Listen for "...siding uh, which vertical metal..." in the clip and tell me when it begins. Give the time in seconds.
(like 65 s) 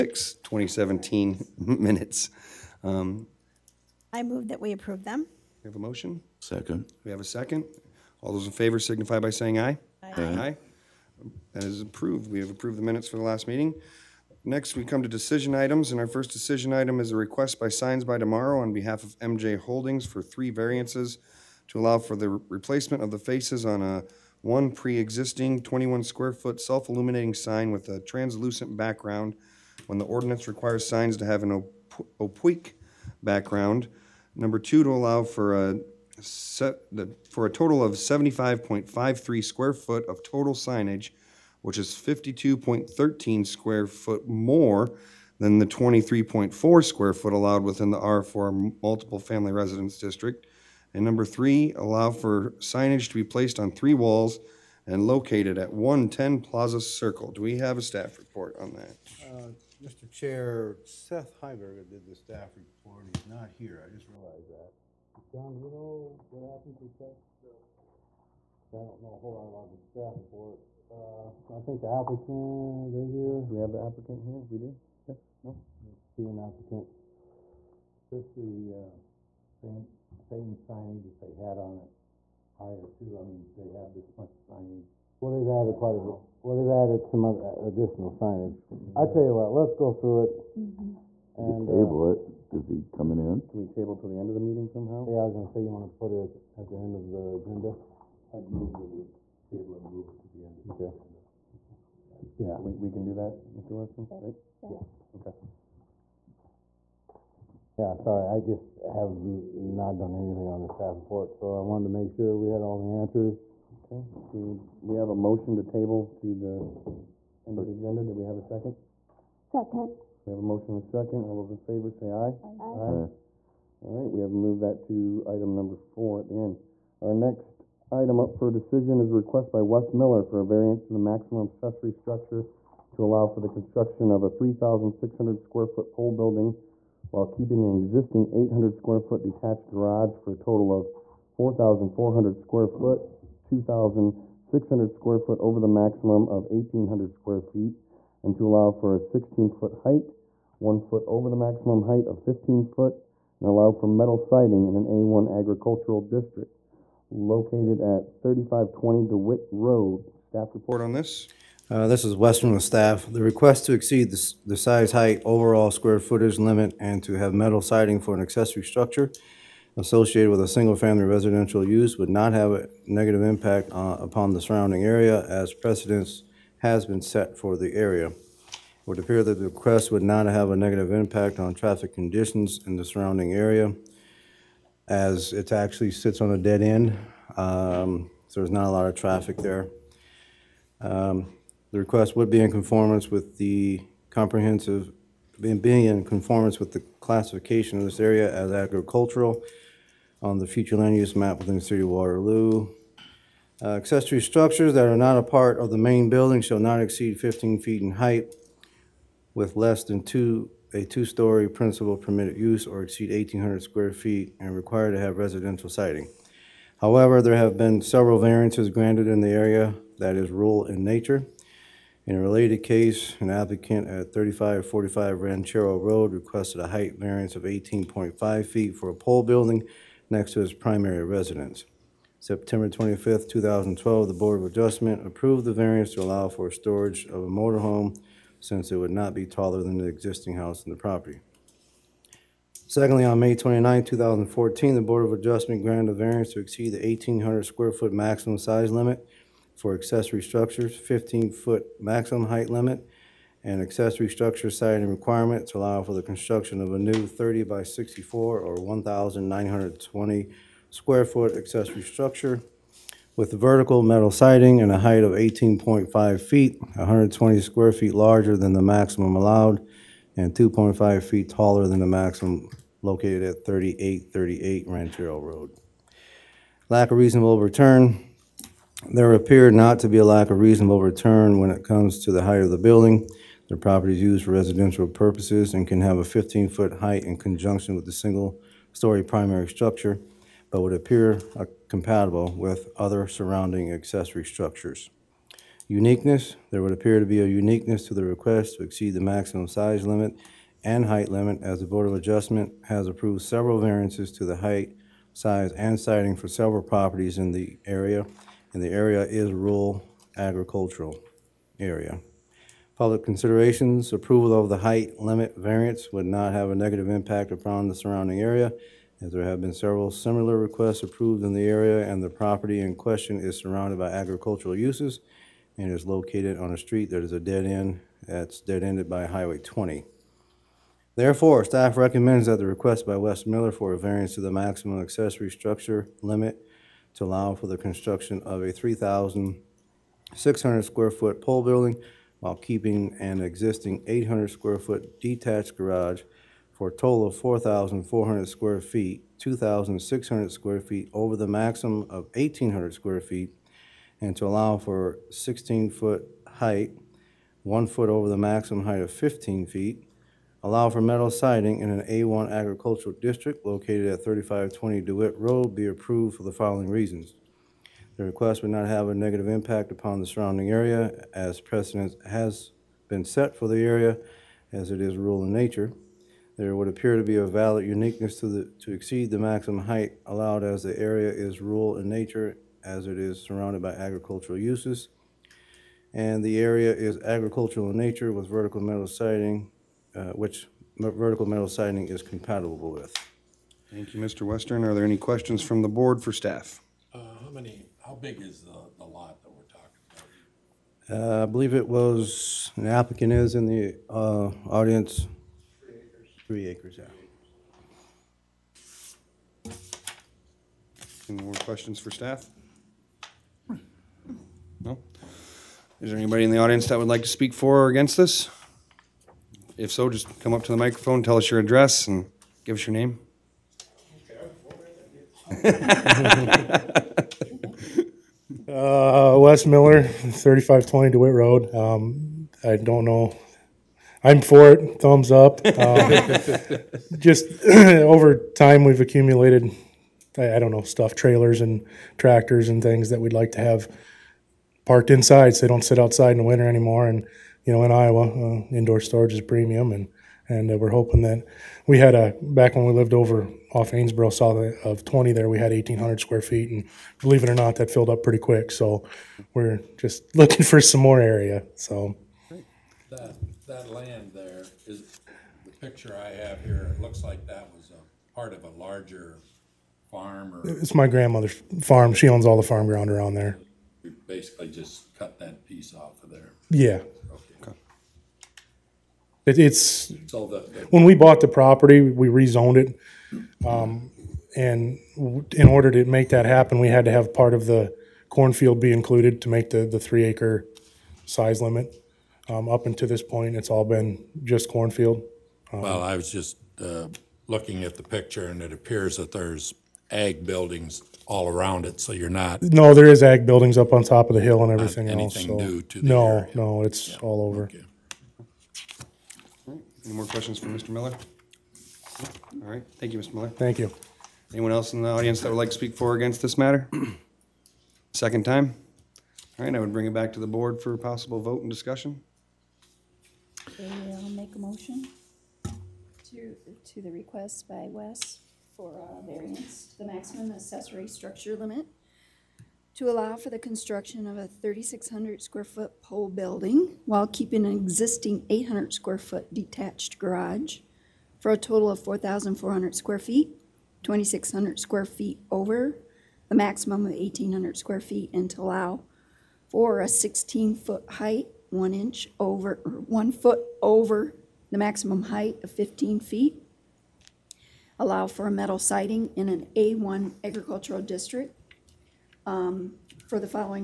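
388 s.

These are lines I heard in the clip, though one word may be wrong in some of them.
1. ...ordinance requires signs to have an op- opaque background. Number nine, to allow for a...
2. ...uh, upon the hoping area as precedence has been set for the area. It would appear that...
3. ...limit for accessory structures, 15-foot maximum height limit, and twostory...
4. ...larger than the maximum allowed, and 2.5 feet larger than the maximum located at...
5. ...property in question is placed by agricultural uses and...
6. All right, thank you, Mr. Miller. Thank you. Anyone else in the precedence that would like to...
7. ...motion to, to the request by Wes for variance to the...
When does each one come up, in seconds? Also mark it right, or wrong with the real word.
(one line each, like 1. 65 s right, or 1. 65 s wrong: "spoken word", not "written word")
1. 30 s wrong: "two", not "nine"
2. 173 s wrong: "surrounding", not "hoping"
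3. 248 s wrong: "accessory", not "twostory"
4. 267 s wrong: "taller", not "larger"
5. 322 s wrong: "surrounded", not "placed"
6. 512 s wrong: "audience", not "precedence"
7. 524 s right.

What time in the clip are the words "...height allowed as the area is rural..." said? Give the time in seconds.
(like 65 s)
379 s.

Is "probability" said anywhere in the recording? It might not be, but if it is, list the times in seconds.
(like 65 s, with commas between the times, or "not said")
not said.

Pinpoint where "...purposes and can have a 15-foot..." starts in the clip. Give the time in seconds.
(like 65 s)
284 s.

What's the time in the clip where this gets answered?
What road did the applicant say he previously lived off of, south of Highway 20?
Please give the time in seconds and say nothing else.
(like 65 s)
453 s.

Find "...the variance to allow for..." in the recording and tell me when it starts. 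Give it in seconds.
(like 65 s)
235 s.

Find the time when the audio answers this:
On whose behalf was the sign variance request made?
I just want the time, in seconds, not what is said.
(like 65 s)
19 s.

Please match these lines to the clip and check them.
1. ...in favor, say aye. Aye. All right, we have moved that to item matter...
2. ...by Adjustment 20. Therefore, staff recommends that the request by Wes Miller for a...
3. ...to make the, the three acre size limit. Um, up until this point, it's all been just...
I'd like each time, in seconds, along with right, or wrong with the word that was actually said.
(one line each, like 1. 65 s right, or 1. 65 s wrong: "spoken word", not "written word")
1. 121 s wrong: "number", not "matter"
2. 328 s wrong: "Highway", not "Adjustment"
3. 489 s right.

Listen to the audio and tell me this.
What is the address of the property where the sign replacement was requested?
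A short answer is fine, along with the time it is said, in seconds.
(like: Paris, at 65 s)
110 Plaza Circle, at 55 s.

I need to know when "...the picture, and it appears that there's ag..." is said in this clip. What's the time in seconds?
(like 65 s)
497 s.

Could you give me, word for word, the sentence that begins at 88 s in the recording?
I tell you what, let's go through it.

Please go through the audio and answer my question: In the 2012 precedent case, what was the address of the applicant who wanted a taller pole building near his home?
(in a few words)
3545 Ranchero Road.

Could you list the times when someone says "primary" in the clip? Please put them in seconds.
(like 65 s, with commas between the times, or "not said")
230 s, 289 s.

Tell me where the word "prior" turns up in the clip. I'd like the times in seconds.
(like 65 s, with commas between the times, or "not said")
82 s.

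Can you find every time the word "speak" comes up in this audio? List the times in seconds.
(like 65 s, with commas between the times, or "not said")
417 s, 515 s.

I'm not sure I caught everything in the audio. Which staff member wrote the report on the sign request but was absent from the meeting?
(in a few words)
Seth Heiberger.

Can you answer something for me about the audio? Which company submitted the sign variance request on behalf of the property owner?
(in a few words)
Signs by Tomorrow.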